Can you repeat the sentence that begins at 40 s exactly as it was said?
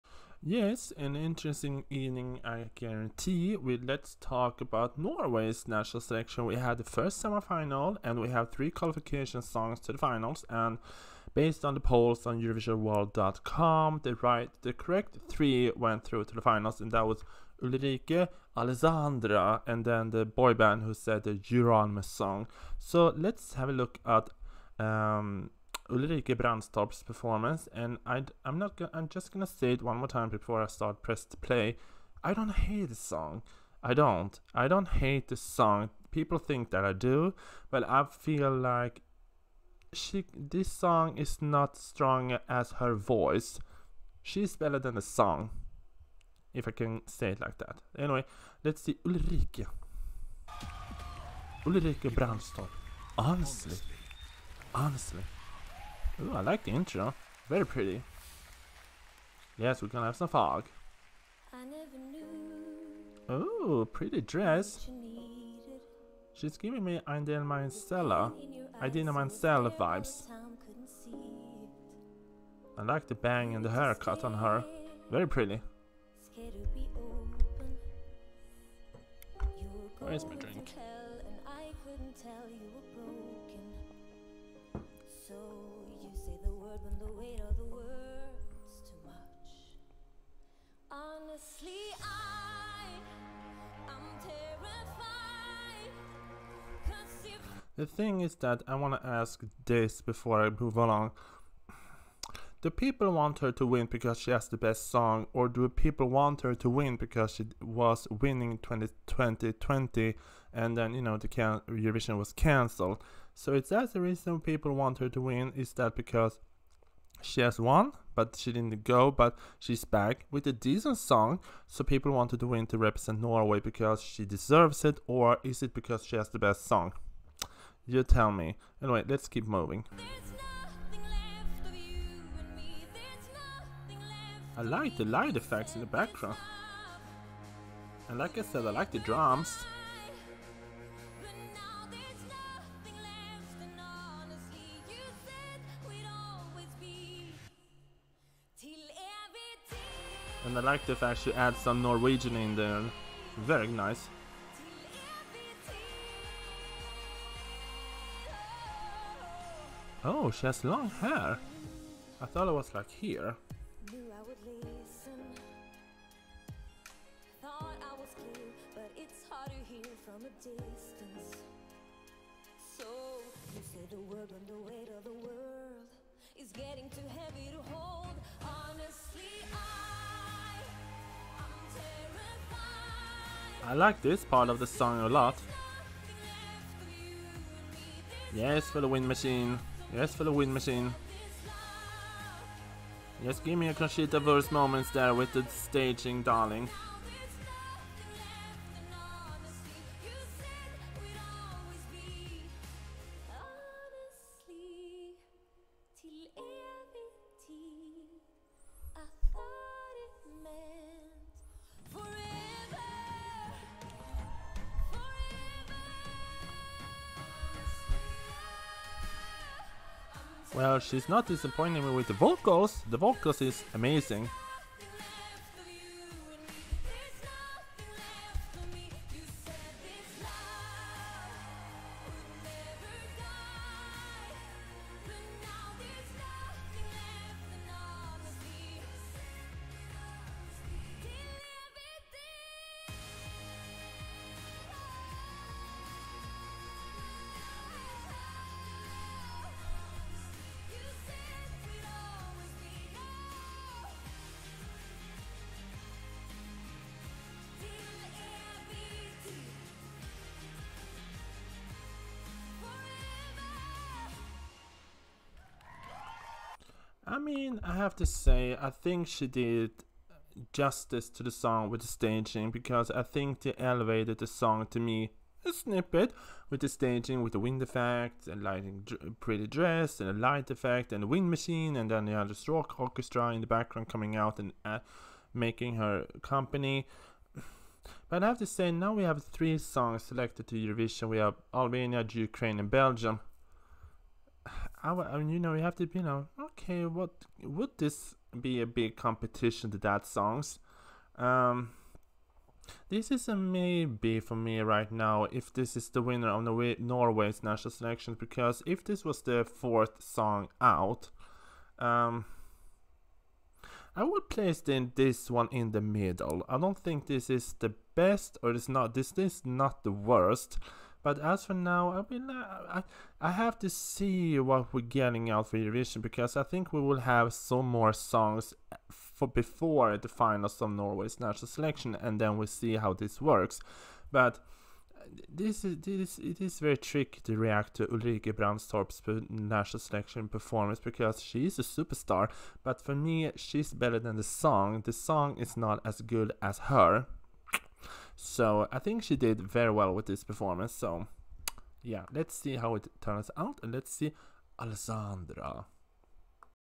This song is not strong as her voice.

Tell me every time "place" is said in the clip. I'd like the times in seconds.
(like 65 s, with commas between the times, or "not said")
314 s.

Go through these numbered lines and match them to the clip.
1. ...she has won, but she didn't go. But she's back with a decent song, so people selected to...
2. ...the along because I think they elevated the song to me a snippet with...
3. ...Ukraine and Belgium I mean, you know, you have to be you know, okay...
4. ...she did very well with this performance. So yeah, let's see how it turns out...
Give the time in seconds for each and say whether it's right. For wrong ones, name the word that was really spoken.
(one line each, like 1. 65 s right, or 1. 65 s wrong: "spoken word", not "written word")
1. 117 s wrong: "wanted", not "selected"
2. 271 s wrong: "staging", not "along"
3. 292 s right
4. 349 s right.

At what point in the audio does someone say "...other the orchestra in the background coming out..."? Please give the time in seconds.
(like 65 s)
282 s.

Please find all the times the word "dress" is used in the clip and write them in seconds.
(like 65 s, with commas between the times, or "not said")
64 s, 279 s.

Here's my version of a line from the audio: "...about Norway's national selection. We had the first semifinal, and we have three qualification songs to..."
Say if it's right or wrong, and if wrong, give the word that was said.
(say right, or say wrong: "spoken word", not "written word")
right.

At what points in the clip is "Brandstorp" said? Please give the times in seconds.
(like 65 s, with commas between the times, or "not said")
26 s, 52 s, 338 s.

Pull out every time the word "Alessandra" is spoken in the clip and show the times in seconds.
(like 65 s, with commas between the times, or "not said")
18 s, 354 s.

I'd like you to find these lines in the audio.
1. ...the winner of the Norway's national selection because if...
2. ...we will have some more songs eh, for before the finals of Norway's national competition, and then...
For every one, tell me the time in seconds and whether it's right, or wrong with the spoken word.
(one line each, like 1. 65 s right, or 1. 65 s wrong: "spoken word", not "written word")
1. 305 s right
2. 326 s wrong: "selection", not "competition".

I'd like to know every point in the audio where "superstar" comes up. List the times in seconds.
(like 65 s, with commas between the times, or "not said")
341 s.